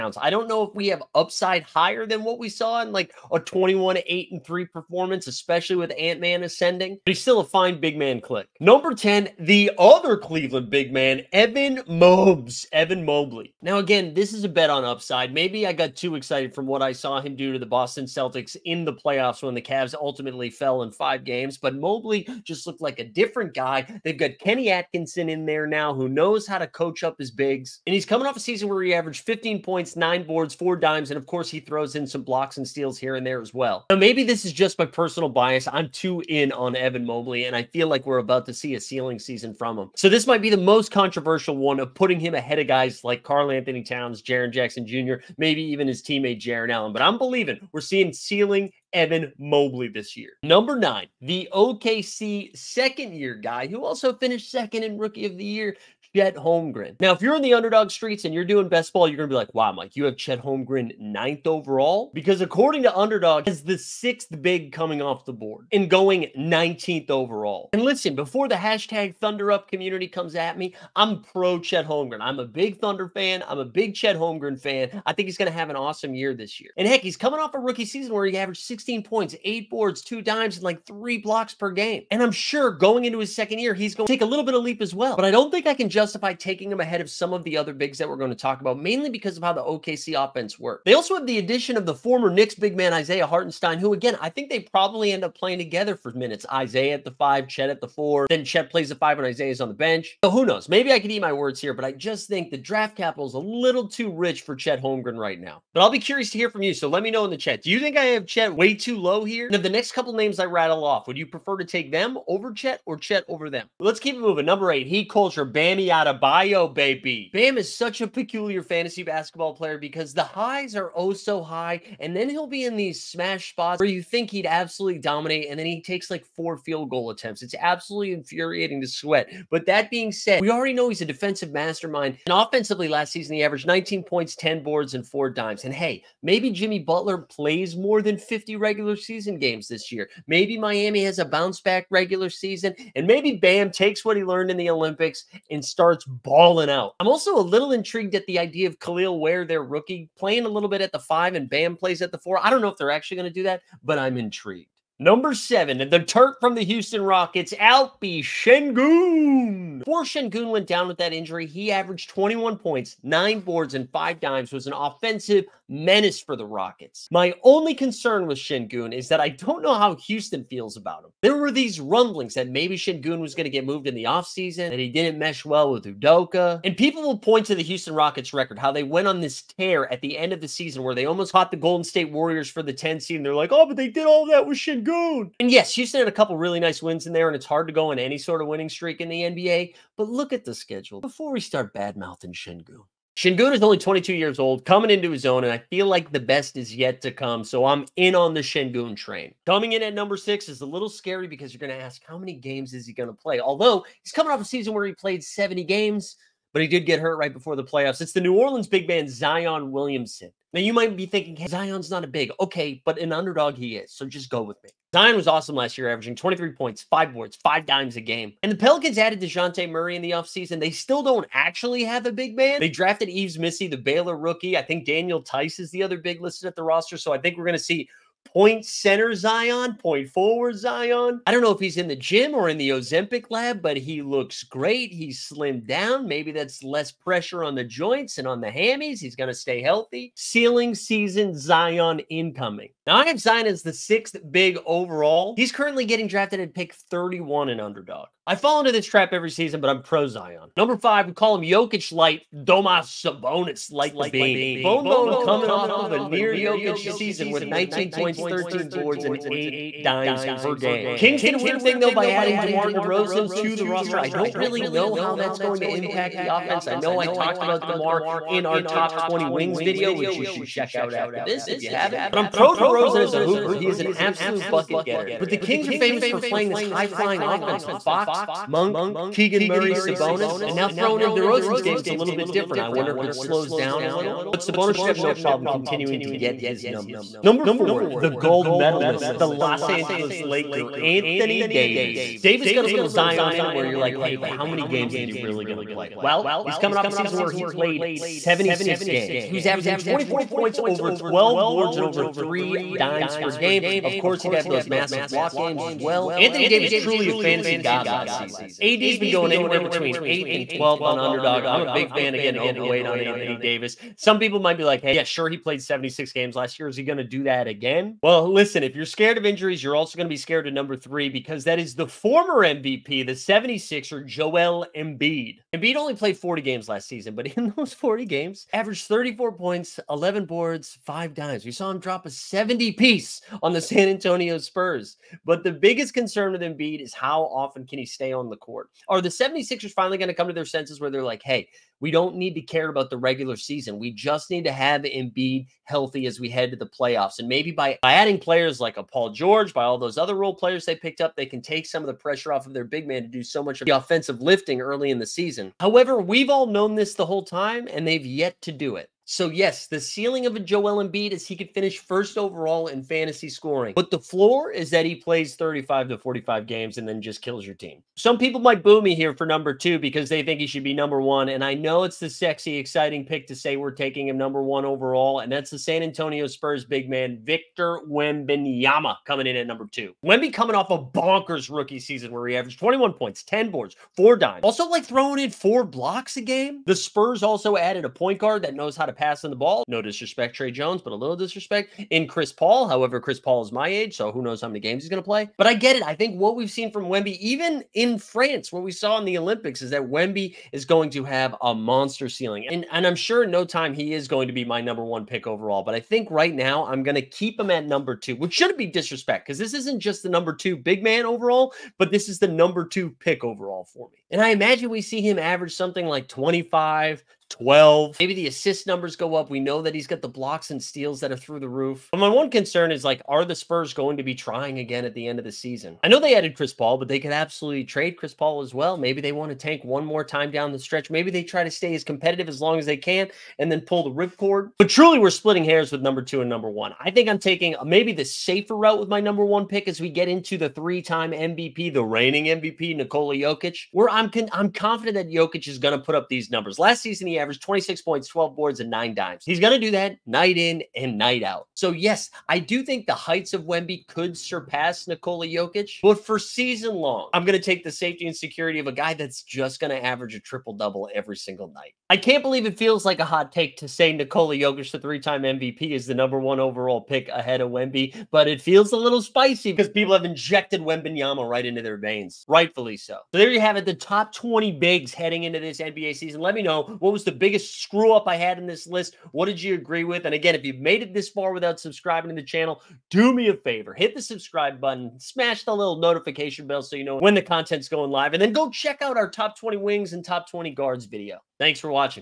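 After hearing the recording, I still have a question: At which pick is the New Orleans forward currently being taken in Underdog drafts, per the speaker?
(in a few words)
31.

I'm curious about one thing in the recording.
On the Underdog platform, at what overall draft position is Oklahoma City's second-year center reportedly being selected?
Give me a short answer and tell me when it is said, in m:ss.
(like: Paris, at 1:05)
19th, at 1:06.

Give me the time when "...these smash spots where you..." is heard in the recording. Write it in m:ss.
2:02.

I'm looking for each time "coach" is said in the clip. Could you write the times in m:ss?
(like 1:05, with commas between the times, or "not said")
0:26.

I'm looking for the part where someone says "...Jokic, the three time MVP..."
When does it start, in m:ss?
7:44.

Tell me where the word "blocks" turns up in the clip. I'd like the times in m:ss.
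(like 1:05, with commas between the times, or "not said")
0:32, 1:21, 5:05, 6:25, 7:00.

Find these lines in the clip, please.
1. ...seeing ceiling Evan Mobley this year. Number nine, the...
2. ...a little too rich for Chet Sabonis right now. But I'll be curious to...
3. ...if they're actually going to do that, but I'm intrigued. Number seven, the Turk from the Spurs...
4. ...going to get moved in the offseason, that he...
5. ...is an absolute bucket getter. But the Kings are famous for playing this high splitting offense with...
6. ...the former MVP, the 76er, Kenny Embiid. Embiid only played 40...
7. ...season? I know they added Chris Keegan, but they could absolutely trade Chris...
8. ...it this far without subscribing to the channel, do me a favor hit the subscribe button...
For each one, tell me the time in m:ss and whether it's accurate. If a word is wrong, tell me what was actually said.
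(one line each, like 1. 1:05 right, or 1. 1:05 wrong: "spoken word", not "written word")
1. 0:47 right
2. 1:43 wrong: "Holmgren", not "Sabonis"
3. 2:32 wrong: "Houston", not "Spurs"
4. 2:53 right
5. 4:33 wrong: "flying", not "splitting"
6. 5:21 wrong: "Joel", not "Kenny"
7. 7:05 wrong: "Paul", not "Keegan"
8. 8:00 right.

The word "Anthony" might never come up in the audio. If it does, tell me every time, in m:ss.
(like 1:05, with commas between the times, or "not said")
0:43, 4:50, 5:06, 5:13.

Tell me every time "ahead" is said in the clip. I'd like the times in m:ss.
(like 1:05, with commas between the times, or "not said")
0:42, 1:26, 7:47.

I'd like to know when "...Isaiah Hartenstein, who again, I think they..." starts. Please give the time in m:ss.
1:32.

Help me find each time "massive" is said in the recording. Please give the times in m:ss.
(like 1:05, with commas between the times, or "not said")
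5:04.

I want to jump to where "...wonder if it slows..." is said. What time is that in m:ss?
4:42.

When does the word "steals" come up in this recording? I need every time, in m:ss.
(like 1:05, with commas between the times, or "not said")
0:32, 7:00.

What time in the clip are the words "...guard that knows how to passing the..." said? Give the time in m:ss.
6:28.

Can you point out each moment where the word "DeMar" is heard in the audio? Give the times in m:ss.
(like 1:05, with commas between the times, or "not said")
4:22, 4:27.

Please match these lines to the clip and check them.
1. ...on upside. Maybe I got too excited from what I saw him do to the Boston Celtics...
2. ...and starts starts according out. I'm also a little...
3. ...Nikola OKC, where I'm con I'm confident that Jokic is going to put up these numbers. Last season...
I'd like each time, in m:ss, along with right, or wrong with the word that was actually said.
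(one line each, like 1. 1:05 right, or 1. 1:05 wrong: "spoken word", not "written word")
1. 0:14 right
2. 2:25 wrong: "balling", not "according"
3. 7:22 wrong: "Jokic", not "OKC".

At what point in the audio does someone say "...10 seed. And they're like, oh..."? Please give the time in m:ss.
3:02.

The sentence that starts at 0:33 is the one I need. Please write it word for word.
Now, maybe this is just my personal bias.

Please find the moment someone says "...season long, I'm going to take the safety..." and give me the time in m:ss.
7:36.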